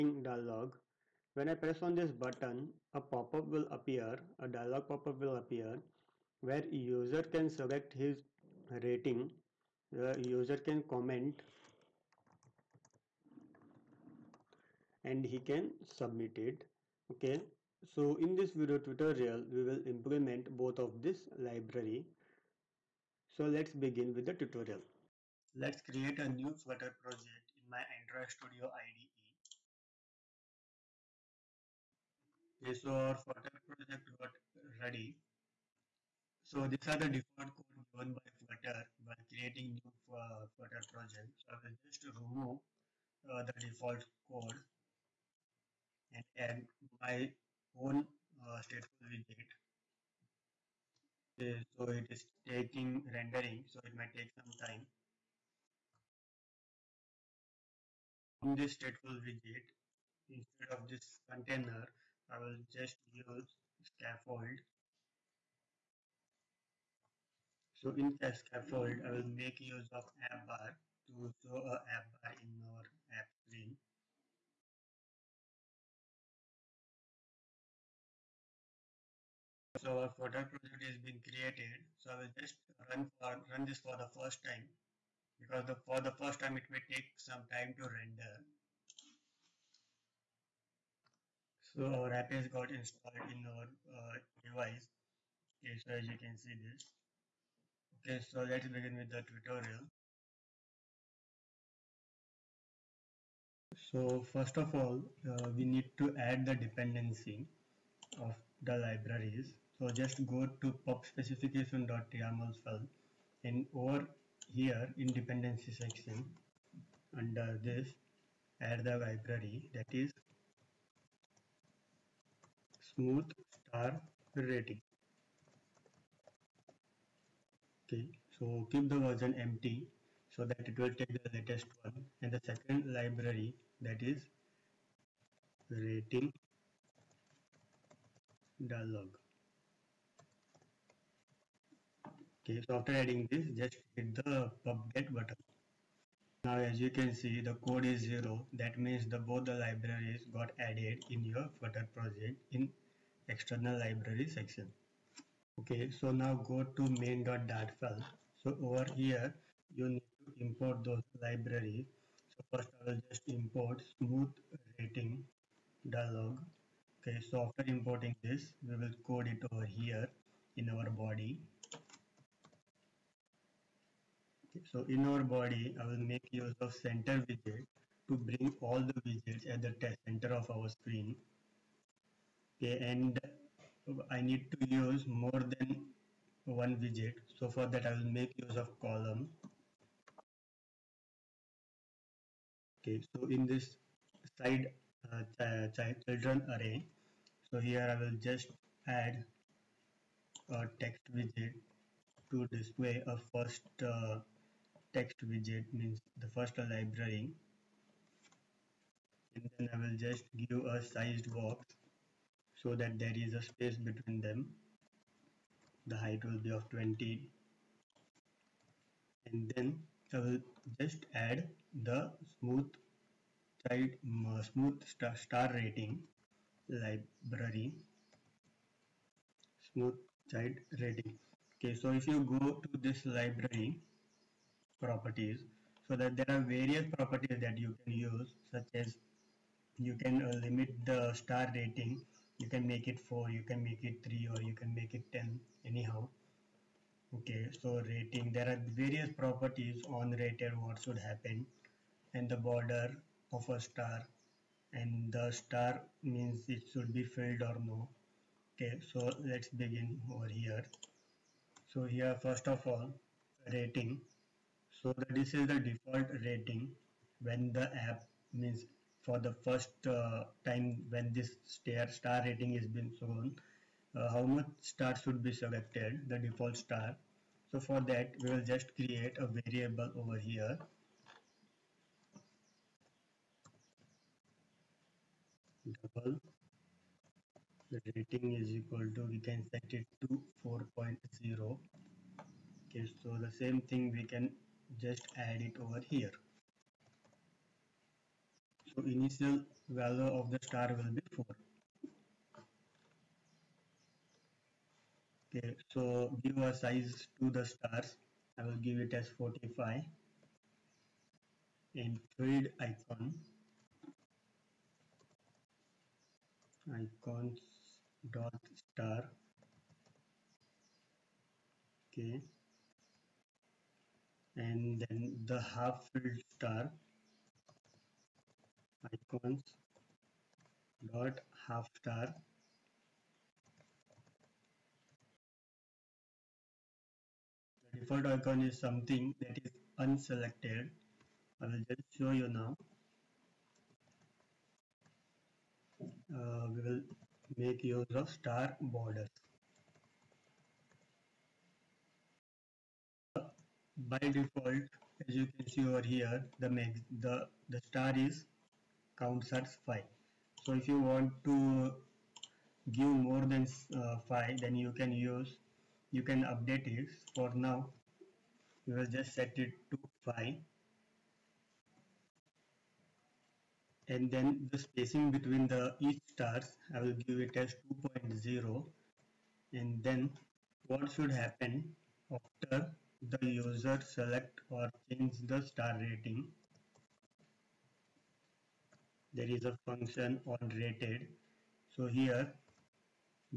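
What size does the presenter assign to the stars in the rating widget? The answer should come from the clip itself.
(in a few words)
45.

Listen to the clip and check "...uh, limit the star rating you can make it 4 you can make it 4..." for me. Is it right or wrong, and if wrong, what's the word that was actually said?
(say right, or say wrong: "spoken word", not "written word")
wrong: "3", not "4".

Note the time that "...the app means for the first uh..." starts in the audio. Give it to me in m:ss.
4:27.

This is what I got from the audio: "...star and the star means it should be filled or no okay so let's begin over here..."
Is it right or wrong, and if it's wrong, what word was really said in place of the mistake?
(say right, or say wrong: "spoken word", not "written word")
right.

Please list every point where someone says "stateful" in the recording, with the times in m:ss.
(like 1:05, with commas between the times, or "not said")
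0:48, 0:58.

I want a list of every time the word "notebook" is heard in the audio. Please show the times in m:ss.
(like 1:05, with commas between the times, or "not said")
not said.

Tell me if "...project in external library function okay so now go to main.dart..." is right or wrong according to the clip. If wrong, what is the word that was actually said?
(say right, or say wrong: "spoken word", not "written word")
wrong: "section", not "function".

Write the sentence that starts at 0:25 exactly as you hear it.
Let's create a new Flutter project in my Android Studio IDE.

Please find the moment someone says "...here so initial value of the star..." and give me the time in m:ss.
4:55.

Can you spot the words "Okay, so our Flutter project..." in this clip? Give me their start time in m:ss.
0:32.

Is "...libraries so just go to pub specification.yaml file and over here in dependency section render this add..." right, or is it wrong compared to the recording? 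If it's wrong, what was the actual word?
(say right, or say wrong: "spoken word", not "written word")
wrong: "under", not "render".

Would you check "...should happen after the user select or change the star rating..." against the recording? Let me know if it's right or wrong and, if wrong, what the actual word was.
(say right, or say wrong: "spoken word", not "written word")
right.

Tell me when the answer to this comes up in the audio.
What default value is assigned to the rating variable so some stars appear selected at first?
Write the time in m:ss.
4:50.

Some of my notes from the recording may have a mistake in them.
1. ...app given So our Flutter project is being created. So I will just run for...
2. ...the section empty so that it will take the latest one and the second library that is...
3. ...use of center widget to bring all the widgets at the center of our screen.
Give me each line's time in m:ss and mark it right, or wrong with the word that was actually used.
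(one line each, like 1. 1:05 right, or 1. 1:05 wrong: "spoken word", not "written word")
1. 1:13 wrong: "screen", not "given"
2. 2:08 wrong: "version", not "section"
3. 2:56 right.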